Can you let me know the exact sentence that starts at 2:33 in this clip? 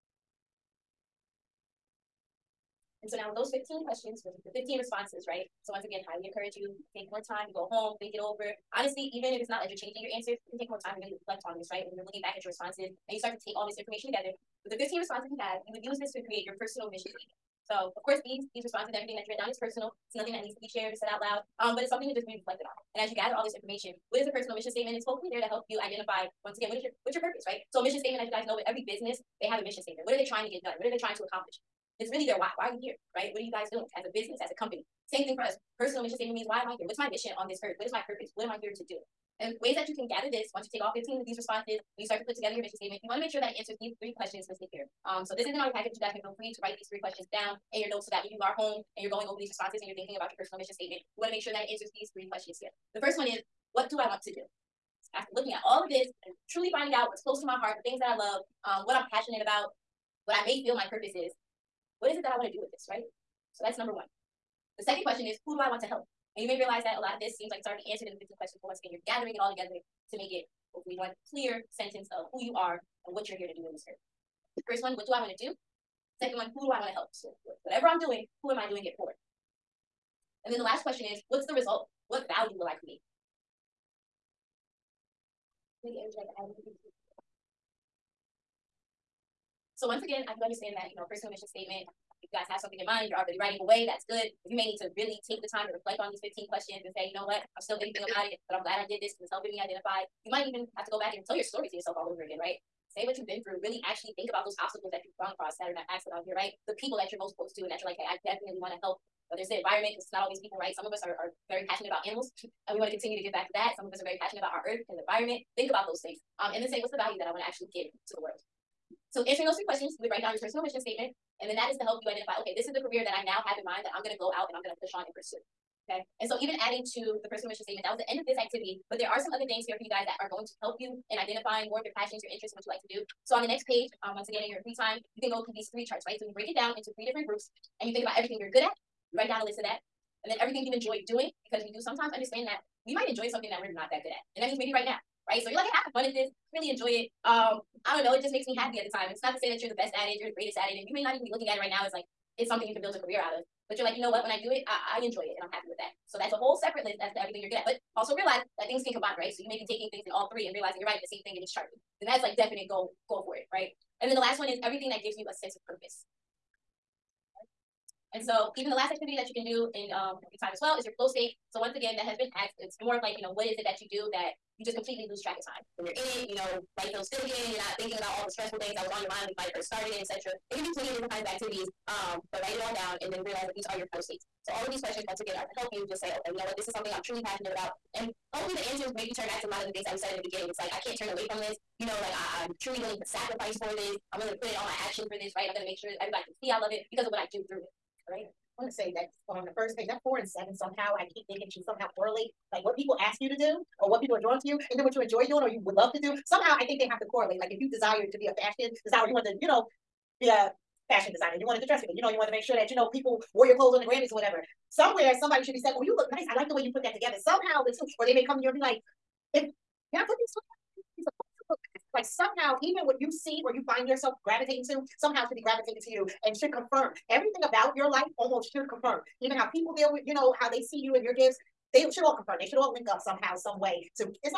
But you're like, you know what?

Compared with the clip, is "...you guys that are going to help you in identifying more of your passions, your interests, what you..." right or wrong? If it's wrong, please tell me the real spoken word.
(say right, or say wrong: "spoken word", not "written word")
right.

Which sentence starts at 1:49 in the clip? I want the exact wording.
Whether it's the environment, because it's not always people, right?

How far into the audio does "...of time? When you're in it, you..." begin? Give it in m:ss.
2:55.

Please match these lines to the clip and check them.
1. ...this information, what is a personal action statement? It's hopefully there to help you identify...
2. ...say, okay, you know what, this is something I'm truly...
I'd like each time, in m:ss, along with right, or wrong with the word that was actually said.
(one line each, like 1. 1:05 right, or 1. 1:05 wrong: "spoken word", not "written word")
1. 0:23 wrong: "mission", not "action"
2. 3:05 right.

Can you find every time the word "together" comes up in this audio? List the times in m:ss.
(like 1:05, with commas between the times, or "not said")
0:14, 0:42, 1:09, 3:36.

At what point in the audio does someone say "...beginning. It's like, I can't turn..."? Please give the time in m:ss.
3:10.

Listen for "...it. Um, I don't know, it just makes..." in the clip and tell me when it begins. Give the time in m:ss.
2:26.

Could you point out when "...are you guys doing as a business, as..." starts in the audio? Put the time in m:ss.
0:33.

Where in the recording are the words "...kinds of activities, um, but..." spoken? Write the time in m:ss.
3:01.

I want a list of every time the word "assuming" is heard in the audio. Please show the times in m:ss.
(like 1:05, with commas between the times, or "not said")
not said.